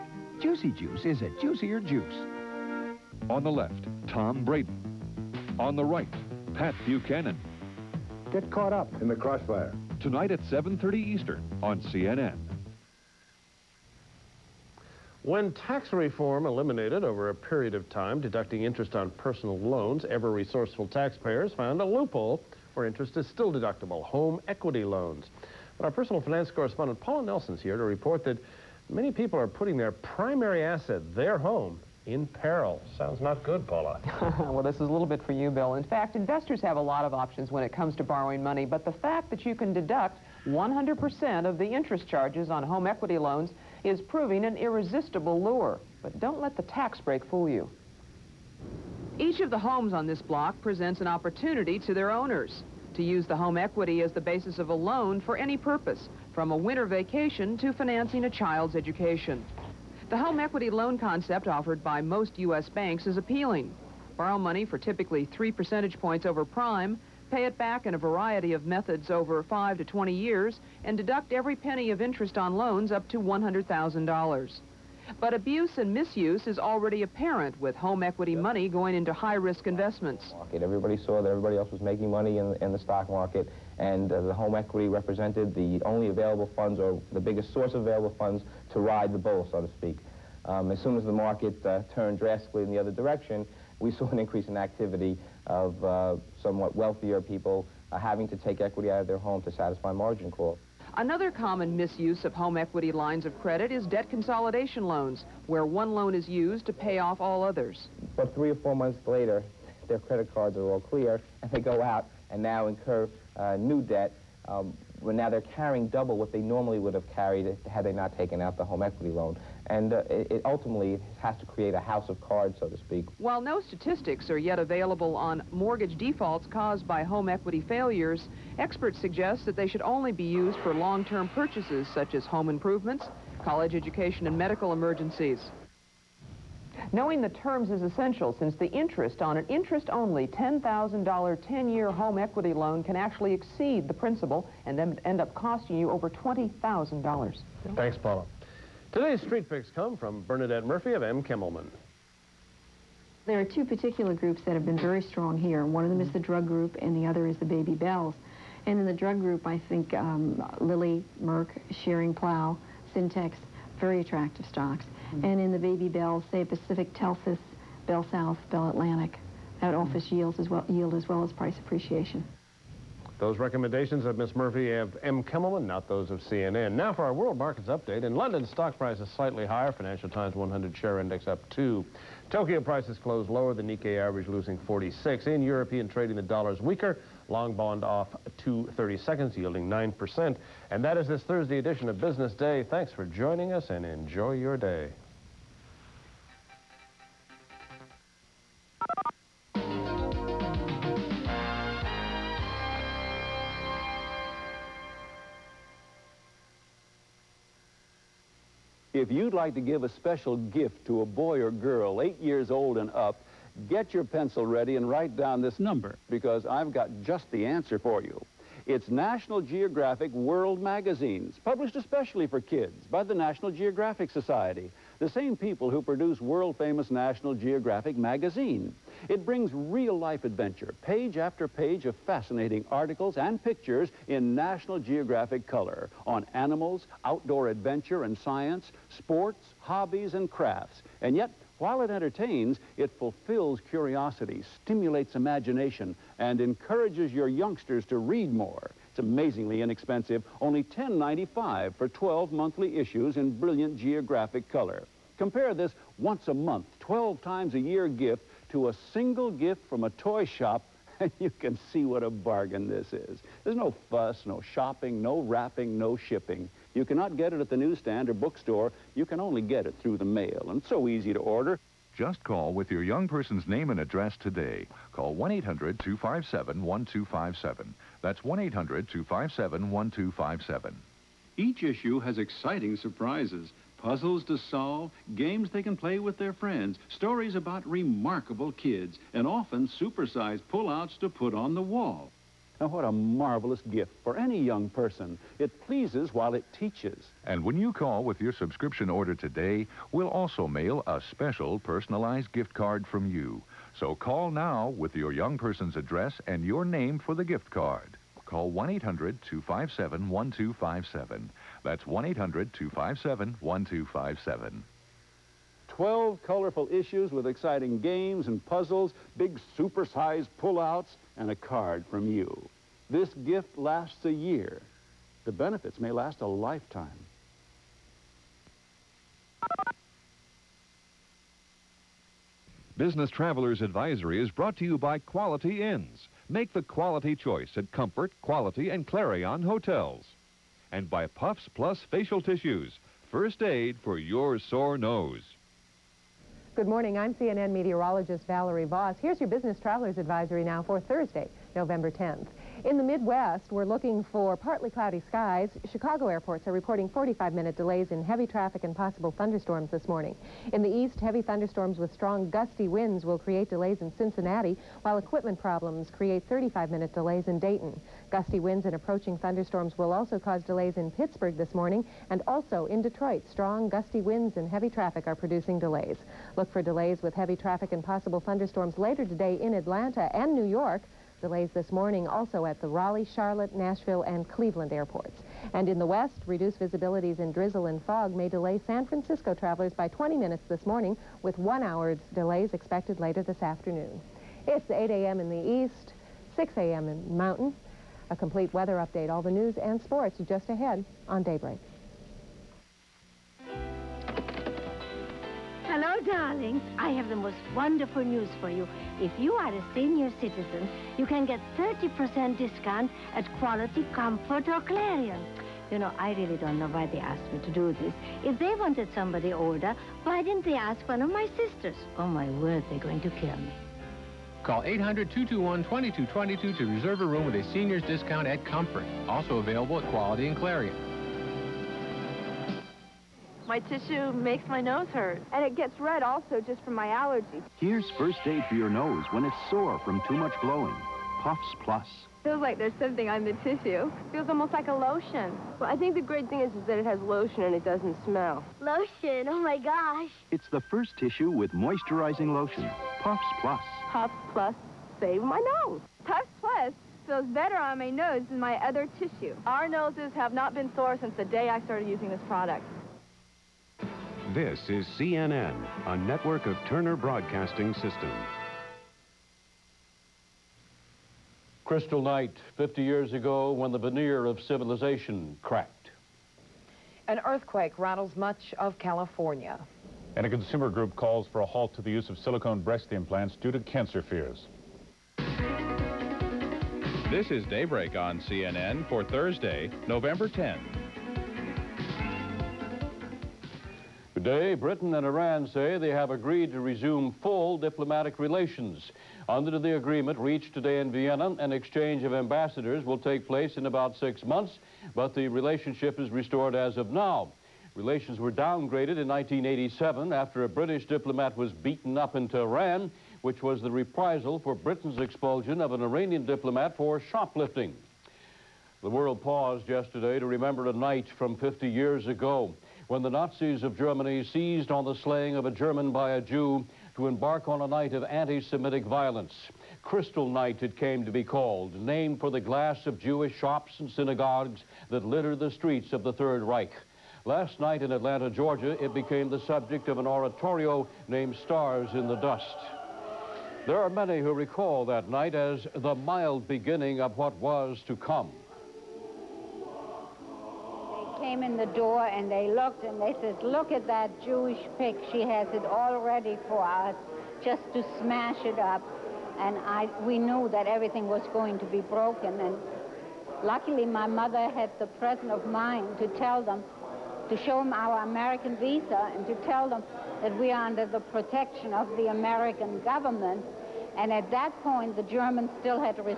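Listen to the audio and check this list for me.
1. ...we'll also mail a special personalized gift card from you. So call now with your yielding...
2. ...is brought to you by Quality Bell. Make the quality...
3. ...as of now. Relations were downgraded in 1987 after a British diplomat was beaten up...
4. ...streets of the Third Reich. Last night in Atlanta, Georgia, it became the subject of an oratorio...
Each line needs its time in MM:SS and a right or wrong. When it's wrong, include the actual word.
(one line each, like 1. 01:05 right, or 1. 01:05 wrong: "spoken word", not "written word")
1. 04:59 wrong: "young", not "yielding"
2. 05:34 wrong: "Inns", not "Bell"
3. 08:26 right
4. 08:55 right.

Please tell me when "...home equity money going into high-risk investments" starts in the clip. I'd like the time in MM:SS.
01:17.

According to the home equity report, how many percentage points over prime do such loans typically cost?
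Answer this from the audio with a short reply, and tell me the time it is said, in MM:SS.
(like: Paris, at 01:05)
3, at 01:05.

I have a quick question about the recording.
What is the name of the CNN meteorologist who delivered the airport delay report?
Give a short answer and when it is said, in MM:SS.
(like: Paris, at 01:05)
Valerie Voss, at 05:48.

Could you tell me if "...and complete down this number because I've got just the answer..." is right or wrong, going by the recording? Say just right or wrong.
wrong.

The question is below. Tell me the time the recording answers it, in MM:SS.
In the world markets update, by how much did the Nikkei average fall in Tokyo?
03:04.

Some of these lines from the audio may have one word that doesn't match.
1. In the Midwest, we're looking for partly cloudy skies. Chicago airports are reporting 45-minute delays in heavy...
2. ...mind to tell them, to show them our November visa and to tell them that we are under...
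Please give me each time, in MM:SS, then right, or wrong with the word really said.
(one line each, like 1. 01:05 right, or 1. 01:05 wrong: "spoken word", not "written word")
1. 05:52 right
2. 09:25 wrong: "American", not "November".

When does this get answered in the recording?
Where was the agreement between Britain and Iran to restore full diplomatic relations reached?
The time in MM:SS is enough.
08:20.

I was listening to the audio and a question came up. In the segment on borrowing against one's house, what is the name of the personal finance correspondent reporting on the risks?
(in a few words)
Paula Nelson.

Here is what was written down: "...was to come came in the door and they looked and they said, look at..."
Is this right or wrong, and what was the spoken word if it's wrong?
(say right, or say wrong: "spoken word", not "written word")
right.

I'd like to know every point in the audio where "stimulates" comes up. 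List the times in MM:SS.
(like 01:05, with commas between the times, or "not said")
04:04.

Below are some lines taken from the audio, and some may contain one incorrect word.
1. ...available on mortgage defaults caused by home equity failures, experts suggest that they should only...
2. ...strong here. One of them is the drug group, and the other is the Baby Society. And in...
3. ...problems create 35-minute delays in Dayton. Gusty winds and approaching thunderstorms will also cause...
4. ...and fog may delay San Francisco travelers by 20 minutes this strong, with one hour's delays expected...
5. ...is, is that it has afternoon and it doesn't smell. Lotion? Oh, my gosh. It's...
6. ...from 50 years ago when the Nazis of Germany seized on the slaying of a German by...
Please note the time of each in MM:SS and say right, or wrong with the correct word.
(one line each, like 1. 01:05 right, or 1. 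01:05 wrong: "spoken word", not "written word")
1. 02:04 right
2. 02:34 wrong: "Bells", not "Society"
3. 06:05 right
4. 06:27 wrong: "morning", not "strong"
5. 07:26 wrong: "lotion", not "afternoon"
6. 08:41 right.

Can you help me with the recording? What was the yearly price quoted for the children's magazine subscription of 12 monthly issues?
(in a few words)
$10.95.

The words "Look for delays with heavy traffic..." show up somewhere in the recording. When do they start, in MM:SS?
06:16.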